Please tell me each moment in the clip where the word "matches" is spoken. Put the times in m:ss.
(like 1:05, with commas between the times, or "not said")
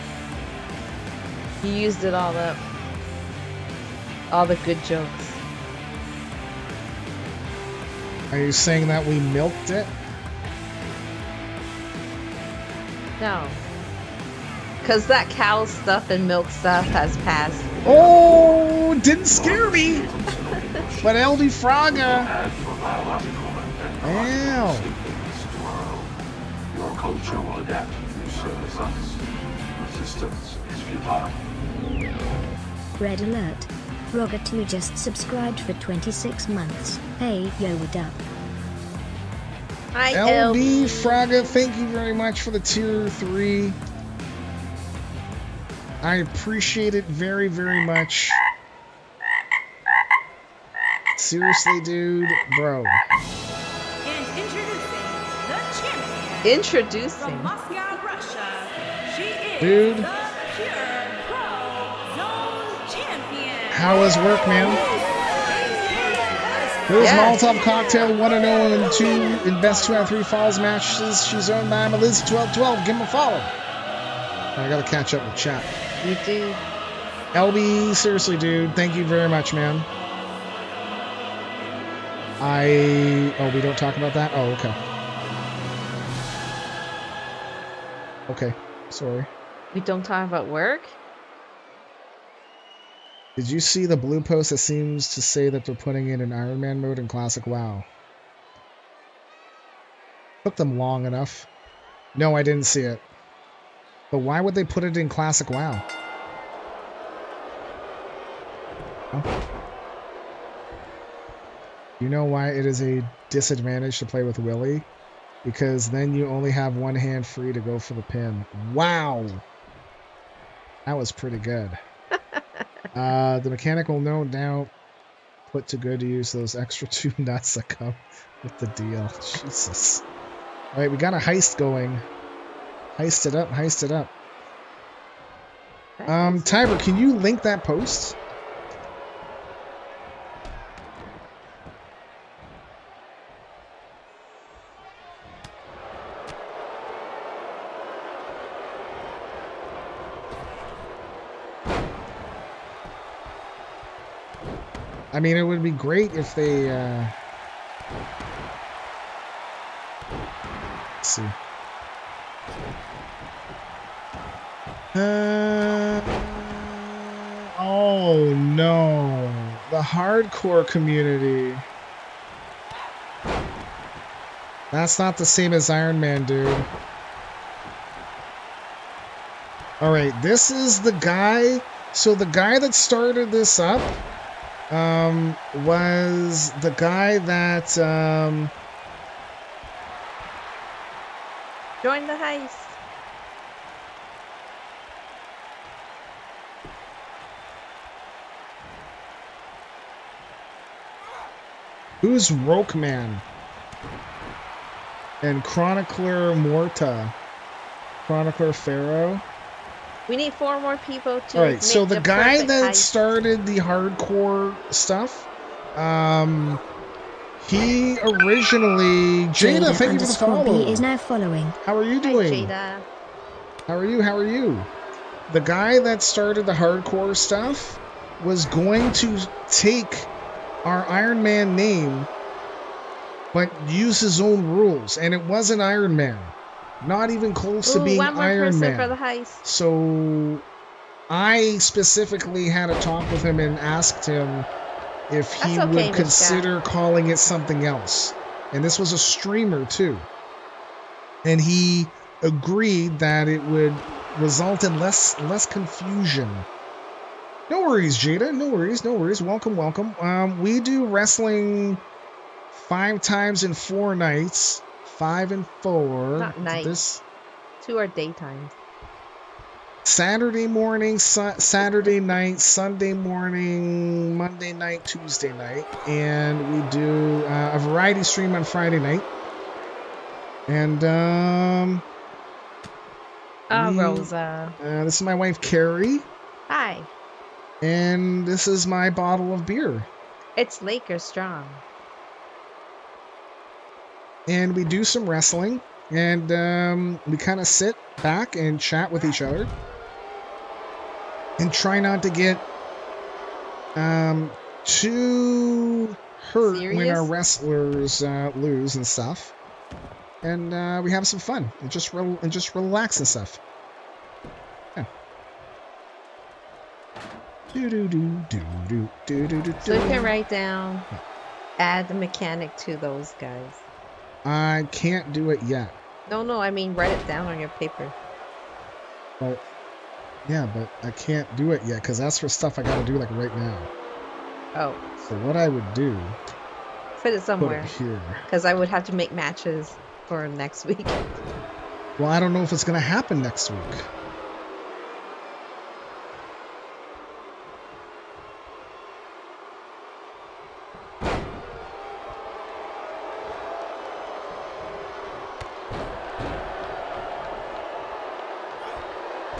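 1:10, 5:39.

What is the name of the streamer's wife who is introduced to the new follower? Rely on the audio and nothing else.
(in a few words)
Carrie.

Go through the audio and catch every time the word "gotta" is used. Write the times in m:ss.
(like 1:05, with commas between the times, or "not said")
1:14, 5:32.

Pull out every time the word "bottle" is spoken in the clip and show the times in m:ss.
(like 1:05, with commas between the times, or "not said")
4:48.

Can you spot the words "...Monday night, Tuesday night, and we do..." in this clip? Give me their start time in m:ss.
4:34.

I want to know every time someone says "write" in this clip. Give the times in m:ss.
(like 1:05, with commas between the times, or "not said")
5:20, 5:26.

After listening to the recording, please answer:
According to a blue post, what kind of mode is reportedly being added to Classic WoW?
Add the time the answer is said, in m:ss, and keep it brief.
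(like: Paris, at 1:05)
Iron Man mode, at 1:36.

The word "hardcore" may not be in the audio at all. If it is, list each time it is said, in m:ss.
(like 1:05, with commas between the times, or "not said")
2:49, 3:33, 3:46.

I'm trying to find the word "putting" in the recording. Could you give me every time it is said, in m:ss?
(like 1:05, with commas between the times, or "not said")
1:35.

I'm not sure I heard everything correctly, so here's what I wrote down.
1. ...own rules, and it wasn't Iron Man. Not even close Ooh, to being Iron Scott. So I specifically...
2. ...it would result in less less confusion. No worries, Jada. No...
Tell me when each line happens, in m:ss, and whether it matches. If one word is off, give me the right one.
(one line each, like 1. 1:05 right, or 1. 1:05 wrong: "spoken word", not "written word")
1. 3:54 wrong: "Man", not "Scott"
2. 4:13 right.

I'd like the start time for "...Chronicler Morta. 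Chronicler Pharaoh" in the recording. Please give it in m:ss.
3:25.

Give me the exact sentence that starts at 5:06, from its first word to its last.
when our wrestlers uh, lose and stuff, and uh, we have some fun and just re- and just relax and stuff.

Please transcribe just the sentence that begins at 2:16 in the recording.
Um, Tiber, can you link that post?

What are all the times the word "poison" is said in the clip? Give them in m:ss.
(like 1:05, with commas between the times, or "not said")
not said.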